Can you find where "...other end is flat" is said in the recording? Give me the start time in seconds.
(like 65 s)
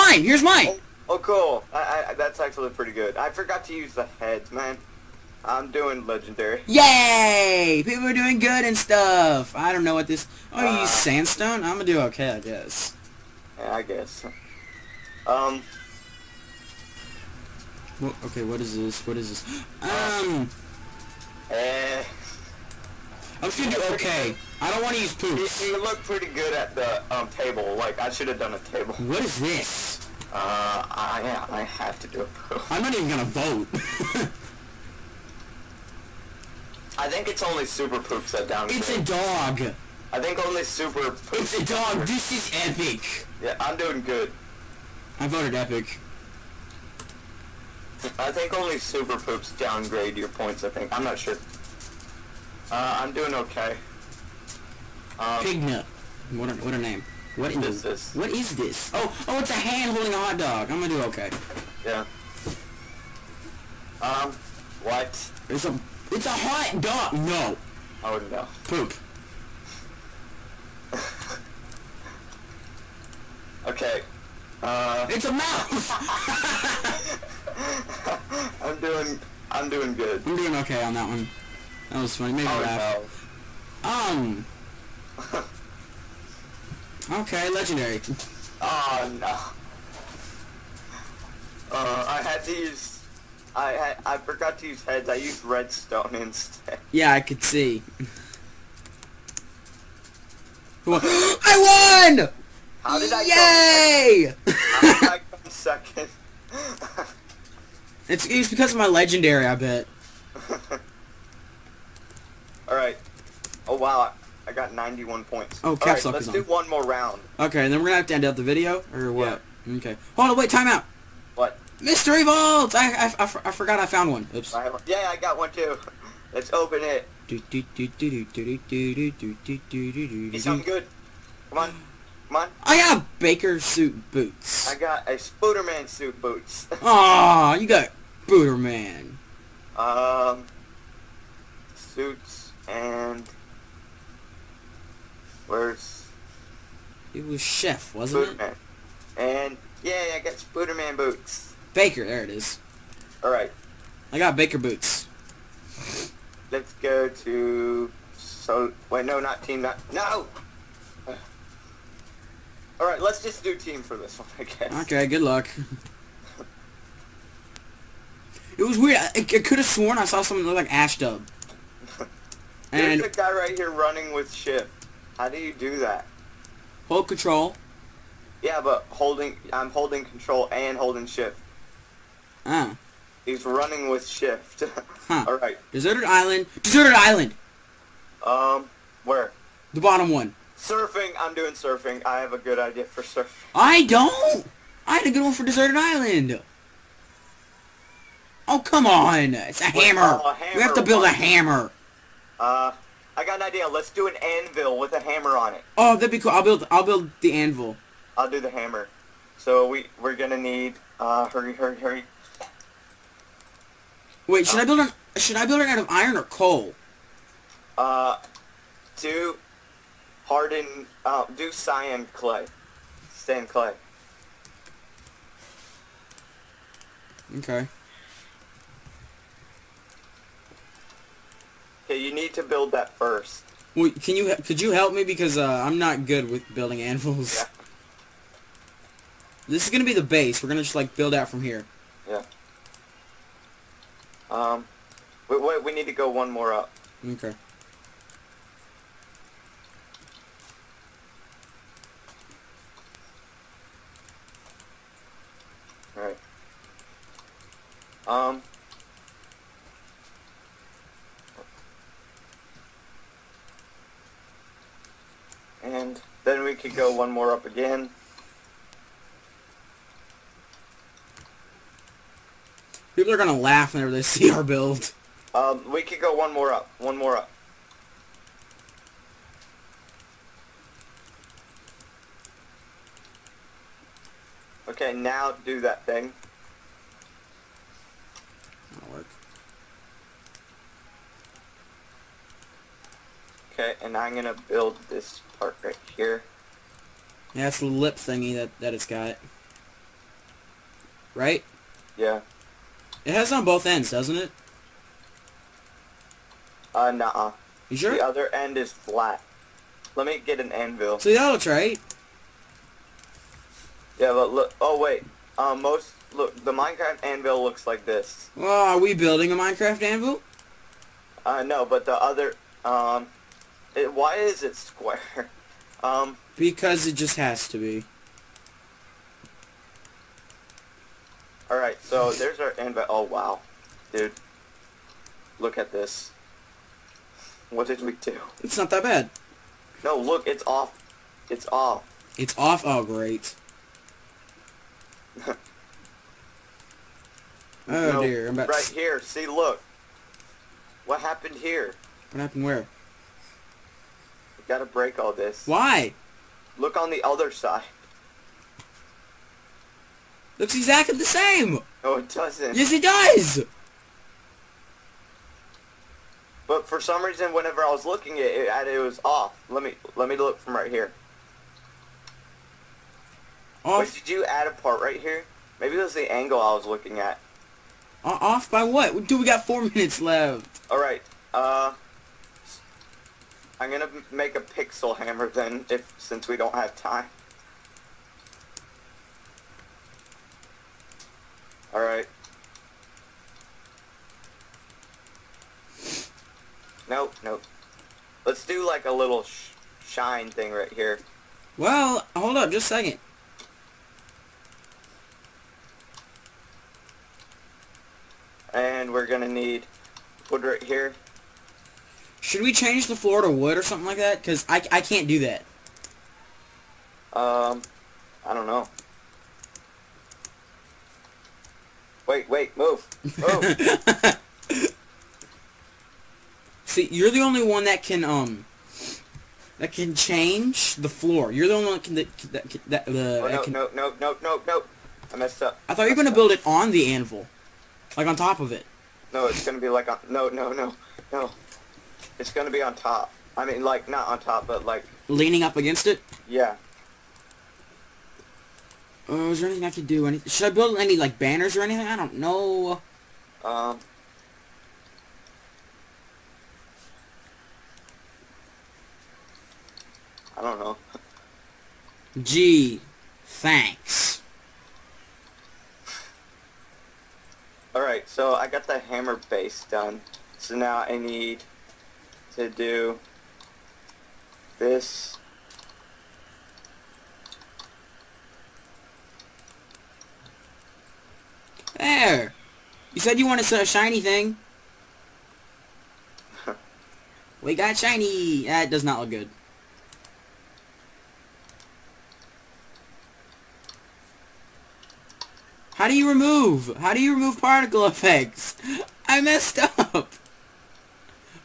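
308 s.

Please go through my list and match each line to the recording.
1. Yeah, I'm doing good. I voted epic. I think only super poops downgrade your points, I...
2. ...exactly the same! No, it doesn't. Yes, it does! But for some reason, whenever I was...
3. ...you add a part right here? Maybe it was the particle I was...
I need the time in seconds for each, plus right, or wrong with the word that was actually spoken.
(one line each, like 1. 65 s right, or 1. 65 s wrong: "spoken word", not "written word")
1. 43 s right
2. 360 s right
3. 374 s wrong: "angle", not "particle".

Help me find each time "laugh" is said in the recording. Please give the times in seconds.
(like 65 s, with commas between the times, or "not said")
82 s, 273 s.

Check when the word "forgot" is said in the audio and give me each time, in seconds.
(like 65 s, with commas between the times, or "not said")
3 s, 94 s, 123 s.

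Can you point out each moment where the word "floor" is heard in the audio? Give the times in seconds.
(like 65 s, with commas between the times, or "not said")
412 s, 430 s.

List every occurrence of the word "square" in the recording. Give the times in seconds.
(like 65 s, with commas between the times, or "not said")
324 s.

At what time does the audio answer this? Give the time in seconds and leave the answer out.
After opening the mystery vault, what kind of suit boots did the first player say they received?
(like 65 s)
133 s.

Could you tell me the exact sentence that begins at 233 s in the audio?
Well, can you could you help me because uh, I'm not good with building anvils.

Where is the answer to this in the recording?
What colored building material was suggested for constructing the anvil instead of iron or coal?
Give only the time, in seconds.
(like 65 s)
221 s.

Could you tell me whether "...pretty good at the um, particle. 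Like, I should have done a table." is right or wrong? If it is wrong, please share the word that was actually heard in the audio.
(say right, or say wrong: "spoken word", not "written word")
wrong: "table", not "particle".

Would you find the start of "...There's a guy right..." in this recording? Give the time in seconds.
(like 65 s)
172 s.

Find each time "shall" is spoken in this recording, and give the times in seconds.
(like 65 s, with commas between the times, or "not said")
not said.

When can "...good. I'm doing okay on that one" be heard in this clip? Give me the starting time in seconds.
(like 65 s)
79 s.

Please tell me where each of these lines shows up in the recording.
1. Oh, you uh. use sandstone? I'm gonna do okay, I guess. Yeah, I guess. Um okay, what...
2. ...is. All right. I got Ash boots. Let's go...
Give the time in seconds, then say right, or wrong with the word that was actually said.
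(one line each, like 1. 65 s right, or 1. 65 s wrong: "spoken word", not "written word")
1. 10 s right
2. 152 s wrong: "Baker", not "Ash".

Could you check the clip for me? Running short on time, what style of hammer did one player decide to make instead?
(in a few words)
Pixel hammer.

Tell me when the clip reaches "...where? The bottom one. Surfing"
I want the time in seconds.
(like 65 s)
189 s.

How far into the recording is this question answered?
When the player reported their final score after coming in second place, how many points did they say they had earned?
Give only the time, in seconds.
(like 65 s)
114 s.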